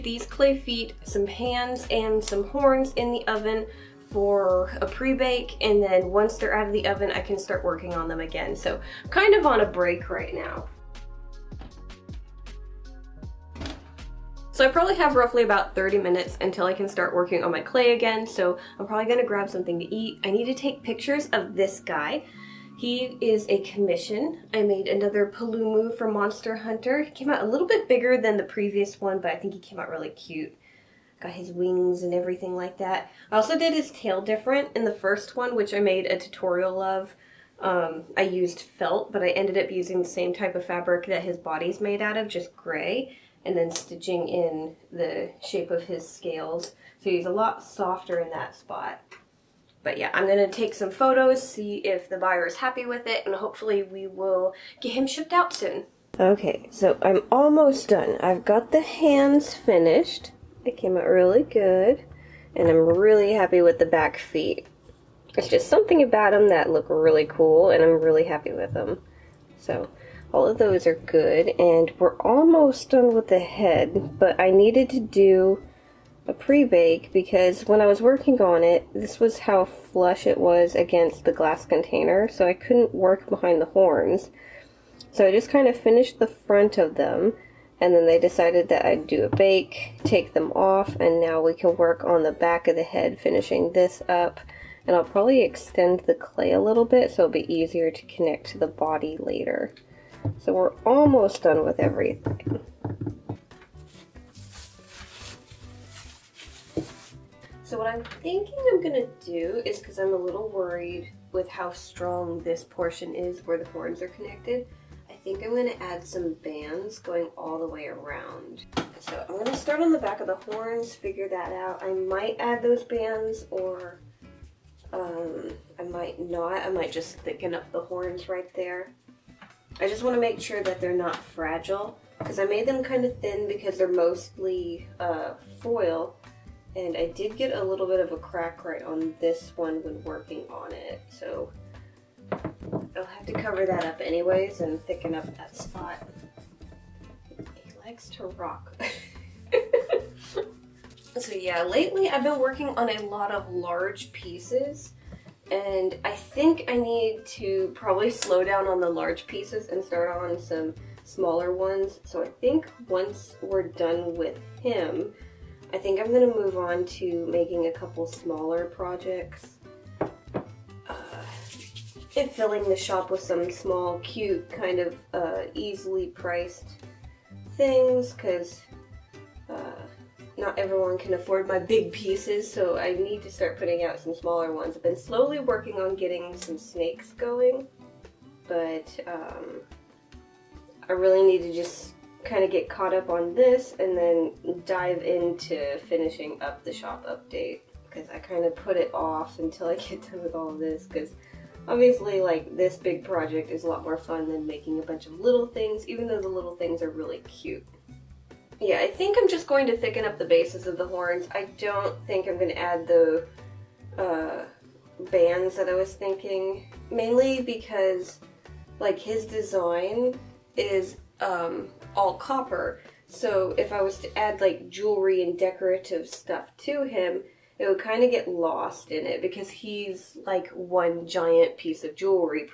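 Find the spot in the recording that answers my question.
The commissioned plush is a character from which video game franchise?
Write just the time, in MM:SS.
00:26.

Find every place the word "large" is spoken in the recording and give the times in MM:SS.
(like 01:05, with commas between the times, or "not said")
02:33, 02:38.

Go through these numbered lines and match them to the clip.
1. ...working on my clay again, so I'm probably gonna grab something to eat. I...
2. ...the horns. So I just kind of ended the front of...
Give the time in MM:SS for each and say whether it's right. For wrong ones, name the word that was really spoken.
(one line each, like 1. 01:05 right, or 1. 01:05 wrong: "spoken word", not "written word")
1. 00:17 right
2. 01:23 wrong: "finished", not "ended".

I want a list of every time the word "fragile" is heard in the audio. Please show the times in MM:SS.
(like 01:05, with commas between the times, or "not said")
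02:11.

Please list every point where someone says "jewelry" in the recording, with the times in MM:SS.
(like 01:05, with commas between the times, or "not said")
03:44, 03:51.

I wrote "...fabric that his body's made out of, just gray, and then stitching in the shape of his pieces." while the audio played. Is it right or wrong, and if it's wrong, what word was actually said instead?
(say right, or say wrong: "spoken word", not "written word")
wrong: "scales", not "pieces".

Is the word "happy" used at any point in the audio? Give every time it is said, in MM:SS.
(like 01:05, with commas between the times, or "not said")
00:52, 01:03, 01:08.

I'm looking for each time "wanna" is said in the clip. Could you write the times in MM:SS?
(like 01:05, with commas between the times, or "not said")
02:10.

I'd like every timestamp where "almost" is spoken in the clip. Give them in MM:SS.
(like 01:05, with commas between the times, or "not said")
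00:57, 01:12, 01:40.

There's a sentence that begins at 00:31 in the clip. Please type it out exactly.
Got his wings and everything like that.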